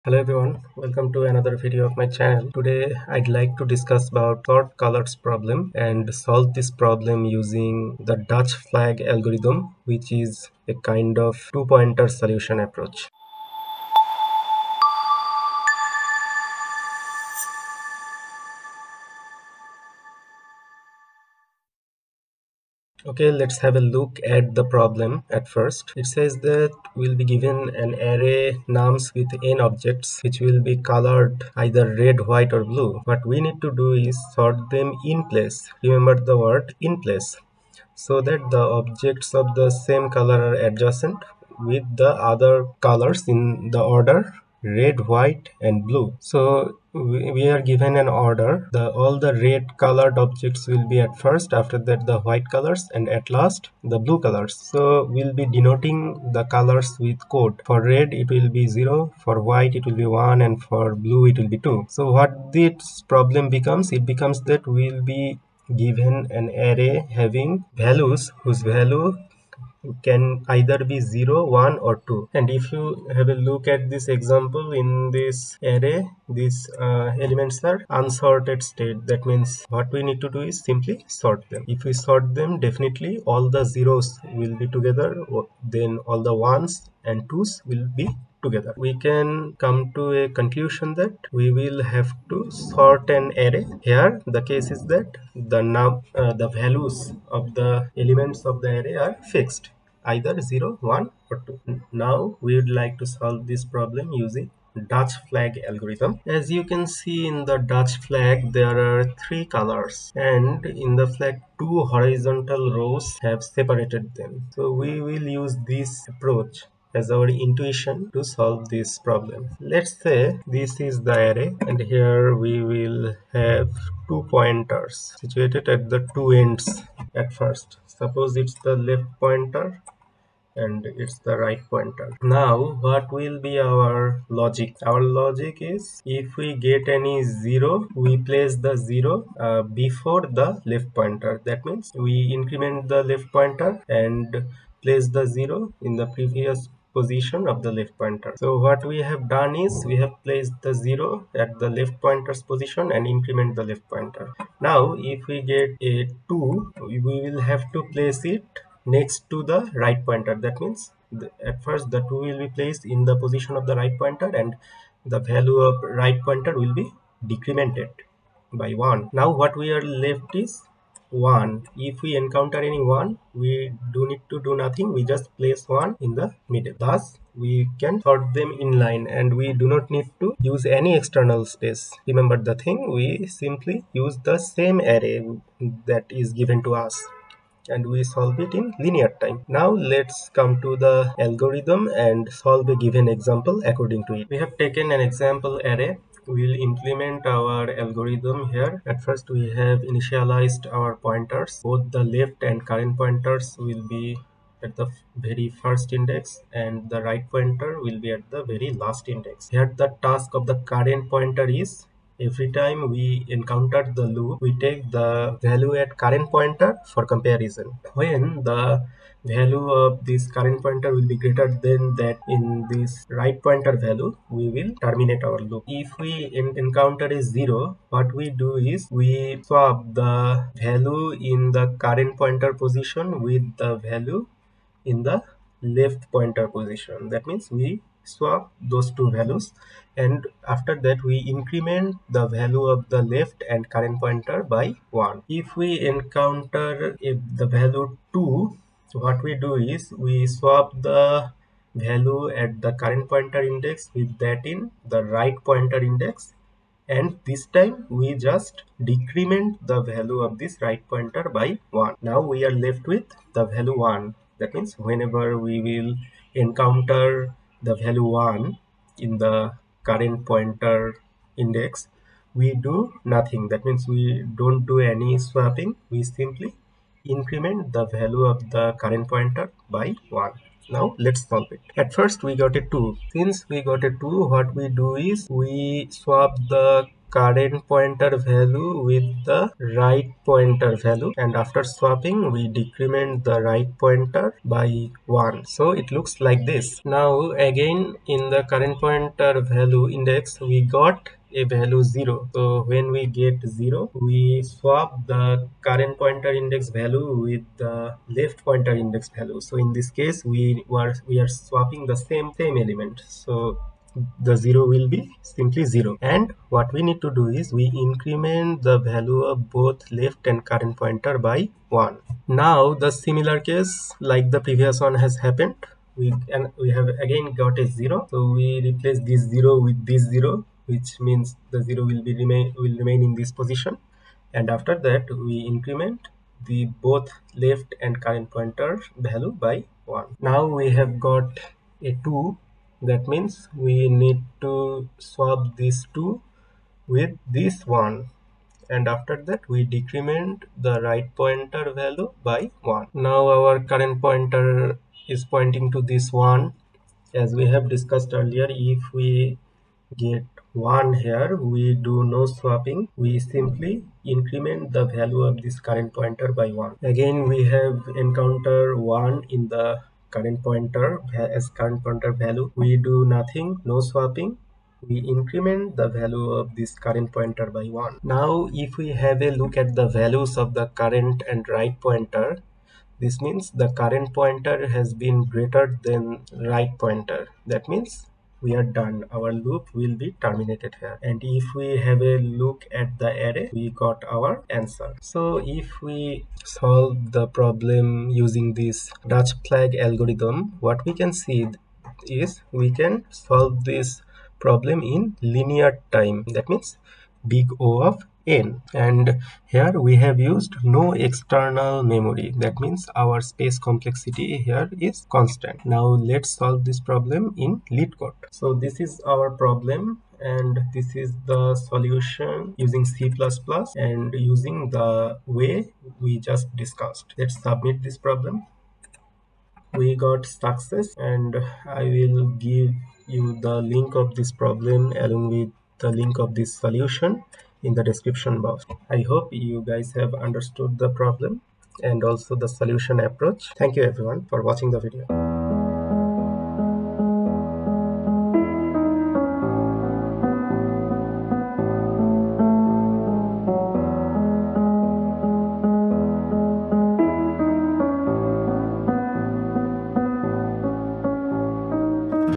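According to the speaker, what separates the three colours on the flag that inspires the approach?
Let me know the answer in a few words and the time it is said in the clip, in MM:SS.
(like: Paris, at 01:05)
two horizontal rows, at 01:51.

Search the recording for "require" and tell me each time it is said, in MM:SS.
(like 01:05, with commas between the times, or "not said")
not said.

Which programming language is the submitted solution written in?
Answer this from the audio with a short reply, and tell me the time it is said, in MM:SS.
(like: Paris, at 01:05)
C++, at 07:02.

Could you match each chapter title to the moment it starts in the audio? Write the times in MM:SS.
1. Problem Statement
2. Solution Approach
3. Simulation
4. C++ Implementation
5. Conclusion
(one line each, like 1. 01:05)
1. 00:23
2. 01:49
3. 03:14
4. 06:58
5. 07:25.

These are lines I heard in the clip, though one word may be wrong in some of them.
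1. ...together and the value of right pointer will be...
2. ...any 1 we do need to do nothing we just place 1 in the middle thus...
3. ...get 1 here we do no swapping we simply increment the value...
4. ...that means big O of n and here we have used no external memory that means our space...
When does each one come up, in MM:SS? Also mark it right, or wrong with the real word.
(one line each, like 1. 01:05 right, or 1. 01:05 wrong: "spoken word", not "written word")
1. 02:43 wrong: "pointer", not "together"
2. 02:52 right
3. 05:59 right
4. 06:46 right.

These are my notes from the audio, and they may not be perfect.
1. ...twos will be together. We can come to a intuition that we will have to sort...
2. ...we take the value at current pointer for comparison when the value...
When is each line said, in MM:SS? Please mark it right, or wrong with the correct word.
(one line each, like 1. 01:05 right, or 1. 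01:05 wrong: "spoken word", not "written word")
1. 01:27 wrong: "conclusion", not "intuition"
2. 03:34 right.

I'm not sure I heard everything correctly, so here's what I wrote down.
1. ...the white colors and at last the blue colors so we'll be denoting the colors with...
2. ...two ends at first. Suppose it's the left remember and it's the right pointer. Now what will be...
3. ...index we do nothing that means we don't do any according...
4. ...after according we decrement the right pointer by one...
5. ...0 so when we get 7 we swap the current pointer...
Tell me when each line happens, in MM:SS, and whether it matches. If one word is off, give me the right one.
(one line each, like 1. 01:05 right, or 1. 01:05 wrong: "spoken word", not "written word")
1. 00:52 right
2. 02:06 wrong: "pointer", not "remember"
3. 04:31 wrong: "swapping", not "according"
4. 04:51 wrong: "swapping", not "according"
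5. 05:01 wrong: "0", not "7".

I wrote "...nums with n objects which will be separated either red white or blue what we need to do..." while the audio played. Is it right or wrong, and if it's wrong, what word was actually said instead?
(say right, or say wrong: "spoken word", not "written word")
wrong: "colored", not "separated".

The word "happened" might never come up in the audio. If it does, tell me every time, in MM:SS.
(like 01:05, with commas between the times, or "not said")
05:25.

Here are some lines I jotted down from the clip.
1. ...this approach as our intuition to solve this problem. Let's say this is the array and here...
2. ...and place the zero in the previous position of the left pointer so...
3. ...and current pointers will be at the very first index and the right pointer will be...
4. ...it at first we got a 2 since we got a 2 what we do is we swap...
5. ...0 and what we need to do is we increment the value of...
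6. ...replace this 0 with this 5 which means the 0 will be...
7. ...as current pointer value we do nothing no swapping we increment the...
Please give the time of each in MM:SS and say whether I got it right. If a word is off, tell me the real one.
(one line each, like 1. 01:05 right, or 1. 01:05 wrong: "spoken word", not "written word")
1. 01:55 right
2. 02:23 right
3. 03:22 right
4. 04:41 right
5. 05:15 right
6. 05:28 wrong: "0", not "5"
7. 06:11 right.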